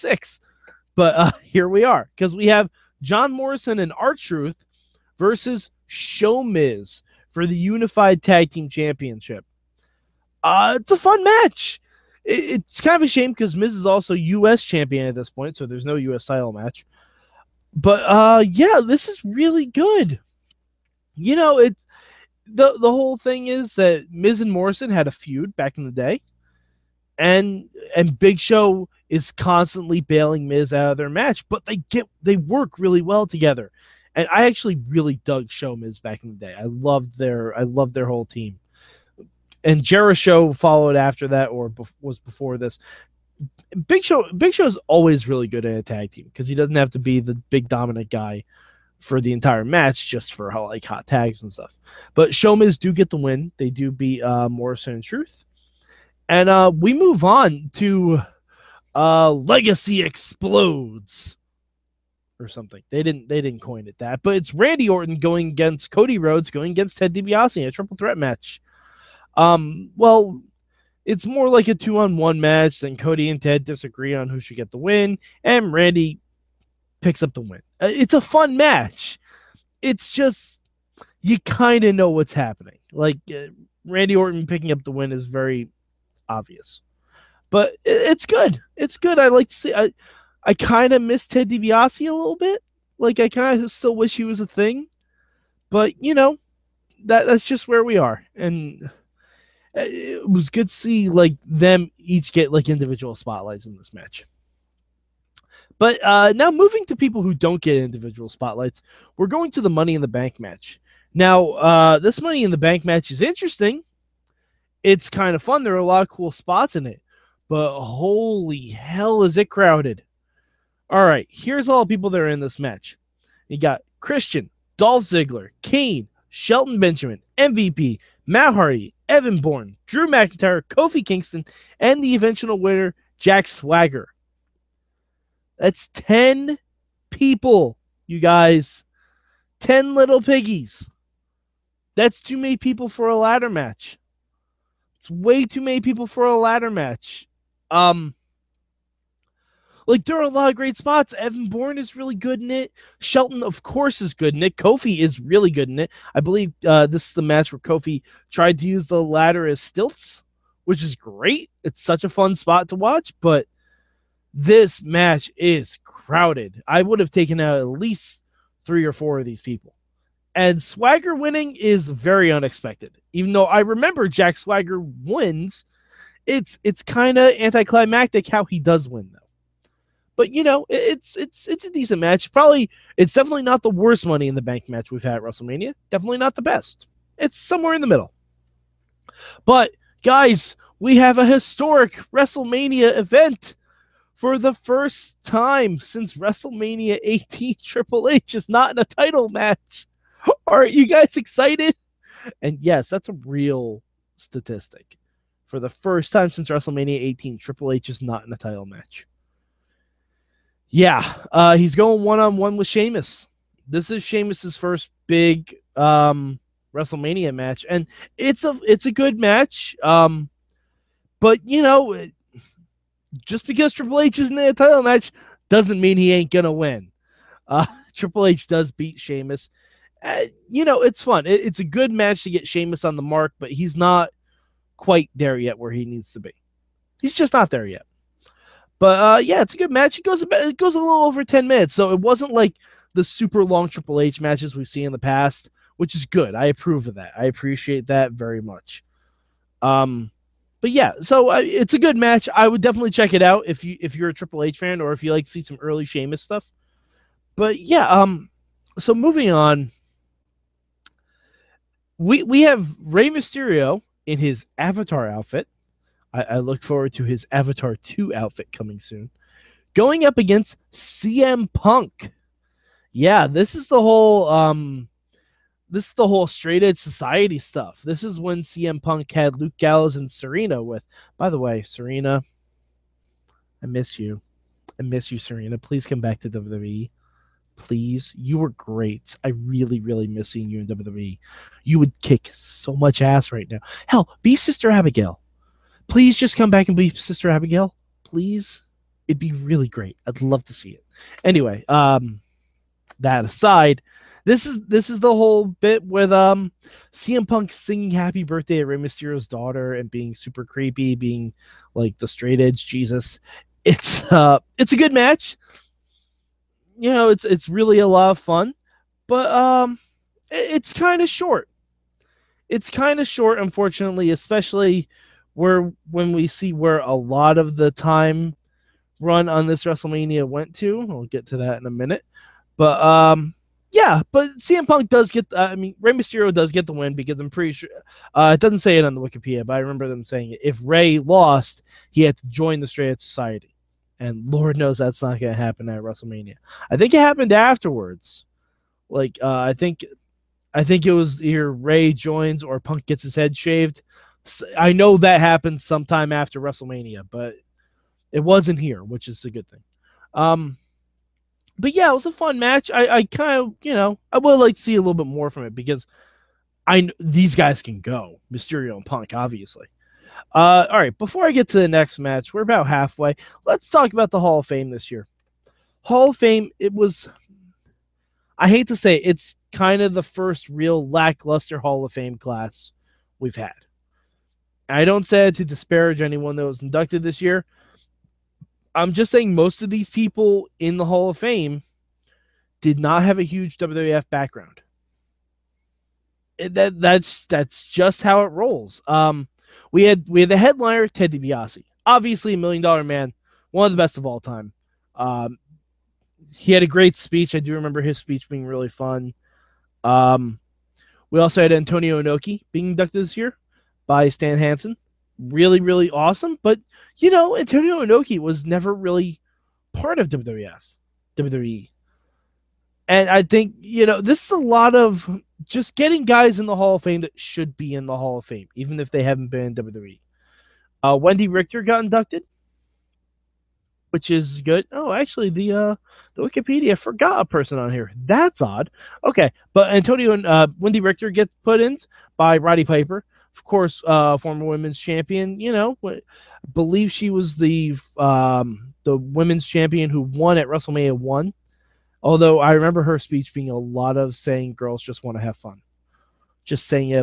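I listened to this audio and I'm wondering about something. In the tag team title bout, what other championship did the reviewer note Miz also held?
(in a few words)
U.S. champion.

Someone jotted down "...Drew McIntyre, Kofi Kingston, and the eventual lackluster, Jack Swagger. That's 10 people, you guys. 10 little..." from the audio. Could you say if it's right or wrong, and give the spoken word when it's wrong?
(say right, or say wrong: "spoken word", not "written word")
wrong: "winner", not "lackluster".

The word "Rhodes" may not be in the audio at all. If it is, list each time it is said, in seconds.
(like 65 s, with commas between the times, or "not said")
66 s.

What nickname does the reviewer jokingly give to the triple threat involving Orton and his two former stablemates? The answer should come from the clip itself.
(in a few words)
Legacy Explodes.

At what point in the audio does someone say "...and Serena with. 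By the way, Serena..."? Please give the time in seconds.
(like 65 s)
279 s.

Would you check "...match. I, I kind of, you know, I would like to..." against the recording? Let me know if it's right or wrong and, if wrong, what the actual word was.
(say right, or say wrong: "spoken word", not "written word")
right.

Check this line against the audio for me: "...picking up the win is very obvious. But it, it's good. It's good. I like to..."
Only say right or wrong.
right.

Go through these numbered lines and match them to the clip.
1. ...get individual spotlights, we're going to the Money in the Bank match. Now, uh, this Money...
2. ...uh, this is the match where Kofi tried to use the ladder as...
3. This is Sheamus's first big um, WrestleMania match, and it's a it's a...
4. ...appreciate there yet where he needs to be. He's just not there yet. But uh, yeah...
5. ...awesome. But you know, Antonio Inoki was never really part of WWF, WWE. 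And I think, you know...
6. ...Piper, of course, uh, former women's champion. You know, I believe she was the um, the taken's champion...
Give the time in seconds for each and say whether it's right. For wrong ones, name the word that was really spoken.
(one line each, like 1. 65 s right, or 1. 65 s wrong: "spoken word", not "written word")
1. 107 s right
2. 156 s right
3. 213 s right
4. 234 s wrong: "quite", not "appreciate"
5. 415 s right
6. 442 s wrong: "women", not "taken".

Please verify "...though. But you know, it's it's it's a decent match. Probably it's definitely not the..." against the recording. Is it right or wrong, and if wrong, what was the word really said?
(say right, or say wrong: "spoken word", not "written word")
right.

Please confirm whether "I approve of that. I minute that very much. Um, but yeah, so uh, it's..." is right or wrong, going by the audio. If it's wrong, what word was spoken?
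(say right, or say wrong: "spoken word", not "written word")
wrong: "appreciate", not "minute".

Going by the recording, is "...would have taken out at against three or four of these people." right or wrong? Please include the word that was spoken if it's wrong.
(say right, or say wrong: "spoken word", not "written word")
wrong: "least", not "against".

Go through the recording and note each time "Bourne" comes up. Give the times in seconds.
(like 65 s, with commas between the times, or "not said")
129 s, 151 s.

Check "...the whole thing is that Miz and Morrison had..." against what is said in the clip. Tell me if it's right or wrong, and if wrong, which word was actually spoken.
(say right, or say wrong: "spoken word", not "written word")
right.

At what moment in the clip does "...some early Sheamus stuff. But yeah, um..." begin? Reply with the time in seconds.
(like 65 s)
255 s.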